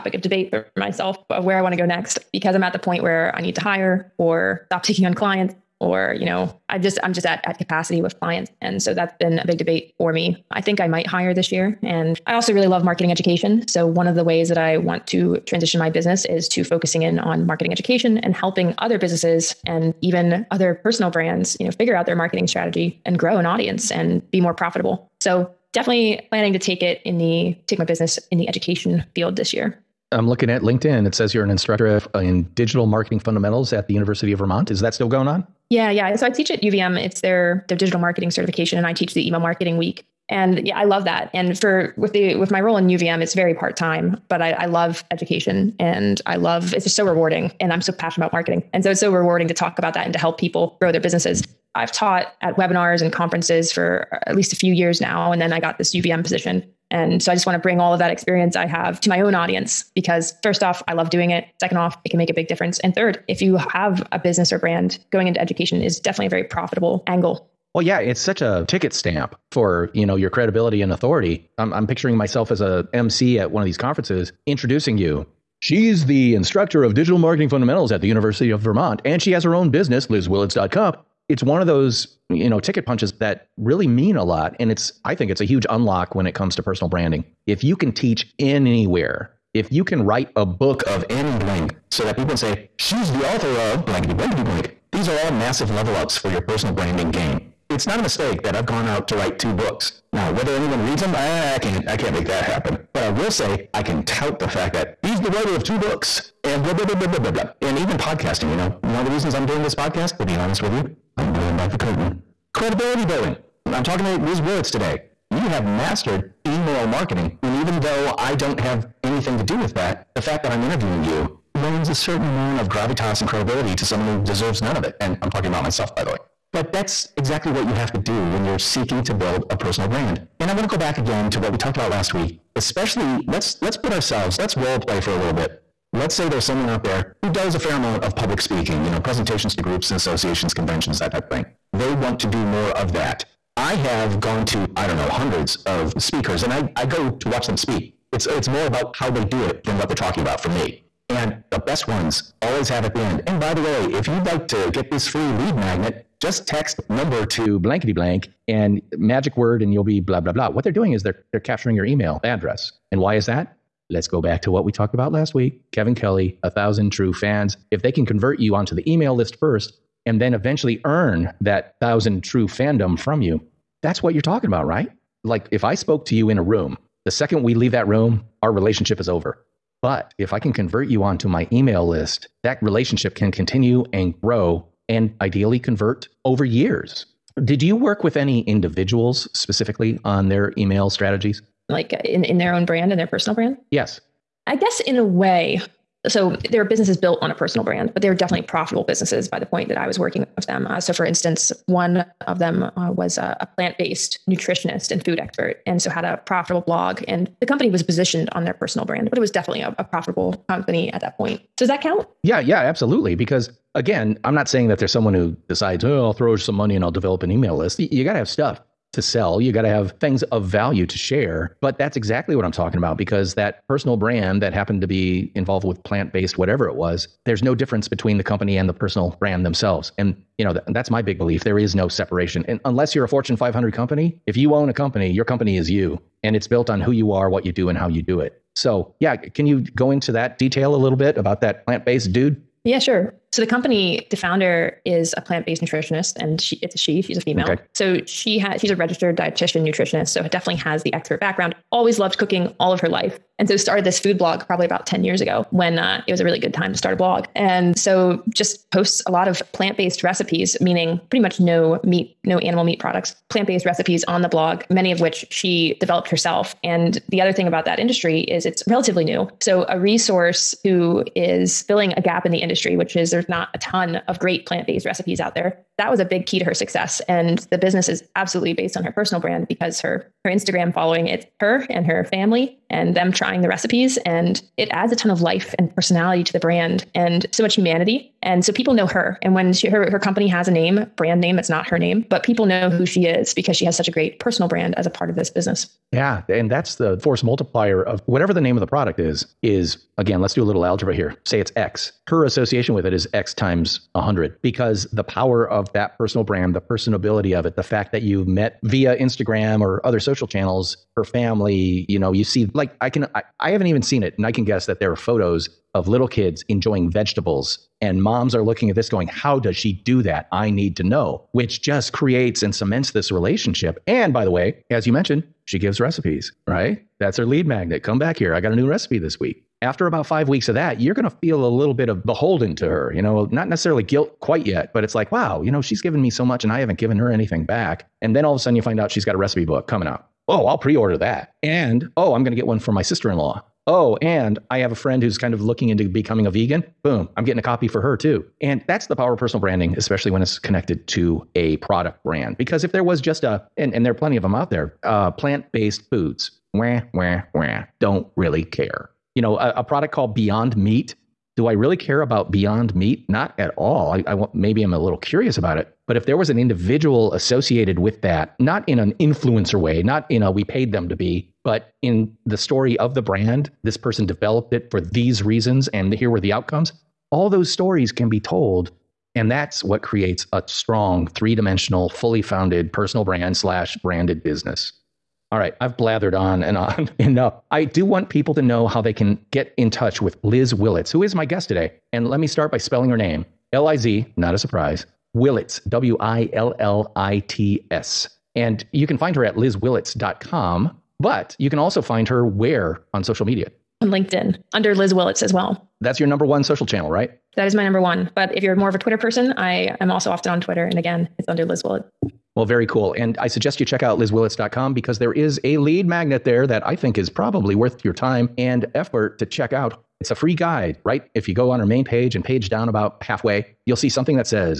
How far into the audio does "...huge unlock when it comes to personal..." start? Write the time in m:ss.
1:25.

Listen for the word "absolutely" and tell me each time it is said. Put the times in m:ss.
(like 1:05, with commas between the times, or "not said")
3:32, 4:38.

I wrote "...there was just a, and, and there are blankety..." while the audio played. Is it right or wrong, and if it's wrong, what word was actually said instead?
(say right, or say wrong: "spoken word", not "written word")
wrong: "plenty", not "blankety".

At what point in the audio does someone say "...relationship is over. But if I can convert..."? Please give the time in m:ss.
2:58.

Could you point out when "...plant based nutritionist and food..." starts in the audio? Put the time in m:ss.
3:23.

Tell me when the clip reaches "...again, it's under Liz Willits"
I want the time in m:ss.
6:50.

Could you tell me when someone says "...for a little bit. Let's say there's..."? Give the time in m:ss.
2:14.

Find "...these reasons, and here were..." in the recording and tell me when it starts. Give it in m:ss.
6:14.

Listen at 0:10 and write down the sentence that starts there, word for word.
I think I might hire this year, and I also really love marketing education.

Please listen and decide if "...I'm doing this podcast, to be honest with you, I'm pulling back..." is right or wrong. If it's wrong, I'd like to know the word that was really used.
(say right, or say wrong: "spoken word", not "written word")
right.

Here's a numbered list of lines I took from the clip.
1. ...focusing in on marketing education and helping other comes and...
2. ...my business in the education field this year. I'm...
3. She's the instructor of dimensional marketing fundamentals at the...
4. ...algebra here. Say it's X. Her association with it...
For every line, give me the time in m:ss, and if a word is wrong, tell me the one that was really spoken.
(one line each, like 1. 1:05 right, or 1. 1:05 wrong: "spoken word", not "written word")
1. 0:16 wrong: "businesses", not "comes"
2. 0:27 right
3. 1:15 wrong: "digital", not "dimensional"
4. 5:00 right.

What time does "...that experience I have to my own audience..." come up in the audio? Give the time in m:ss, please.
0:57.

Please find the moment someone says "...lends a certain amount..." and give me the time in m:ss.
2:01.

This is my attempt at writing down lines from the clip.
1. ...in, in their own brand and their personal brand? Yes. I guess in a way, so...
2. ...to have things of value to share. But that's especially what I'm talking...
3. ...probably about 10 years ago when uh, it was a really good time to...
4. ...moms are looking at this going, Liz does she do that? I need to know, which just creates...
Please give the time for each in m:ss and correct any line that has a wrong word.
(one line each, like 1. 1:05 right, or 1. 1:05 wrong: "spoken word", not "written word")
1. 3:12 right
2. 3:39 wrong: "exactly", not "especially"
3. 4:14 right
4. 5:18 wrong: "How", not "Liz".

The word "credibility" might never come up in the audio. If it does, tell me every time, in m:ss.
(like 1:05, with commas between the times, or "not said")
1:10, 1:52, 2:03.